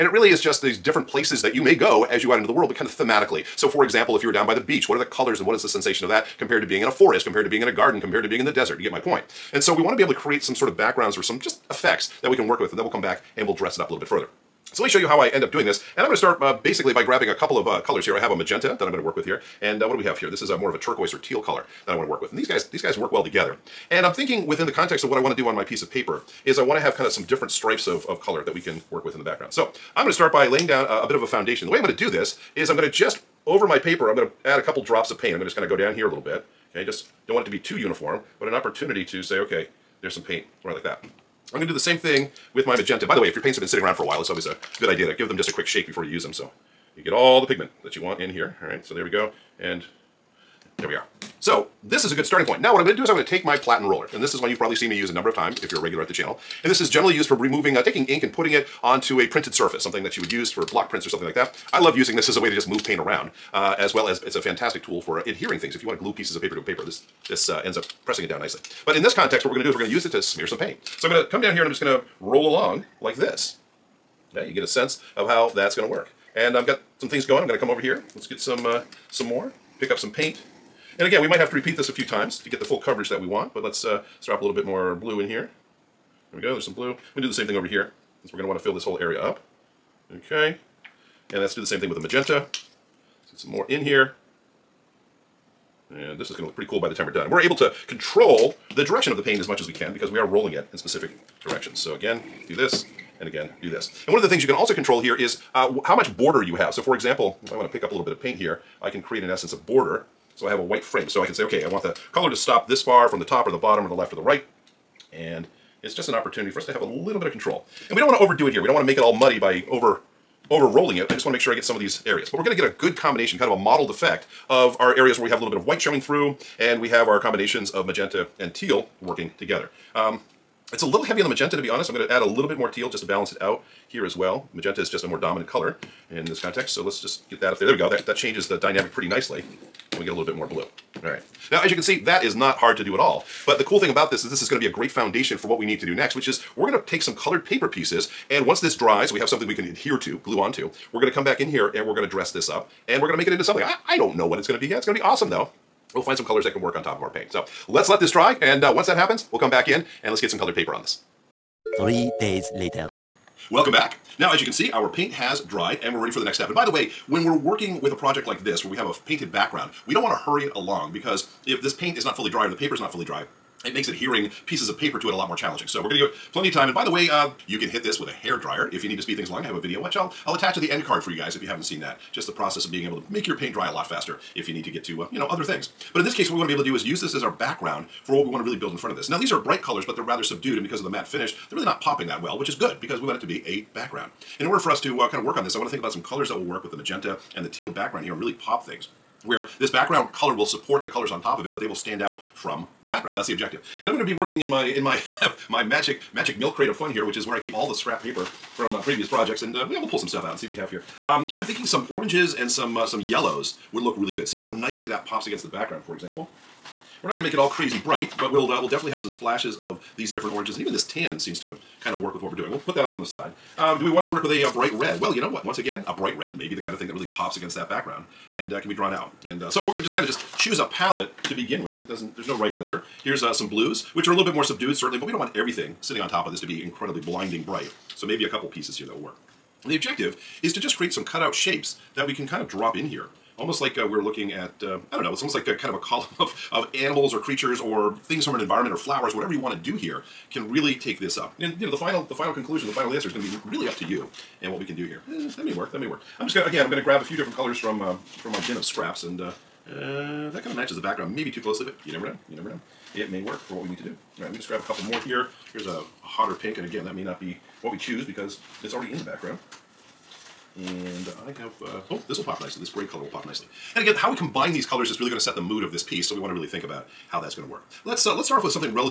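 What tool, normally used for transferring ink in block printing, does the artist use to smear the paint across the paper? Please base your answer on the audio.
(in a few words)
Platen roller.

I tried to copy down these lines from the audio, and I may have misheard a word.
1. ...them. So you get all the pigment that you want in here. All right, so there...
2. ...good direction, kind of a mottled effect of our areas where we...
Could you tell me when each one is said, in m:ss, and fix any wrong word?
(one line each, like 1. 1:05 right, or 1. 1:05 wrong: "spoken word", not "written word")
1. 0:46 right
2. 2:02 wrong: "combination", not "direction".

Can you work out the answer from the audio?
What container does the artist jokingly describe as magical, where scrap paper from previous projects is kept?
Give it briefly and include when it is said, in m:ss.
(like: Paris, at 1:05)
Milk crate, at 3:26.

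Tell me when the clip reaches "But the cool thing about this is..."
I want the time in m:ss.
2:23.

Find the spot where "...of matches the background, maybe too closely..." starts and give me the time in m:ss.
4:20.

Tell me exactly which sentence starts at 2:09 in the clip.
Um, it's a little heavy on the magenta to be honest.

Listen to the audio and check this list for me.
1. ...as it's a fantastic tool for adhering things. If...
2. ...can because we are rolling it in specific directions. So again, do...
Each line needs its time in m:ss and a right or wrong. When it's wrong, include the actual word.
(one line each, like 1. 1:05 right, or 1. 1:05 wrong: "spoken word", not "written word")
1. 1:04 right
2. 1:39 right.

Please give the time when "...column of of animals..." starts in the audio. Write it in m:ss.
4:05.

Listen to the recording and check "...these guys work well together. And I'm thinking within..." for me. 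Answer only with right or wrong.
right.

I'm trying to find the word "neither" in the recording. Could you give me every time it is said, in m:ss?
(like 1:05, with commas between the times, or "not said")
not said.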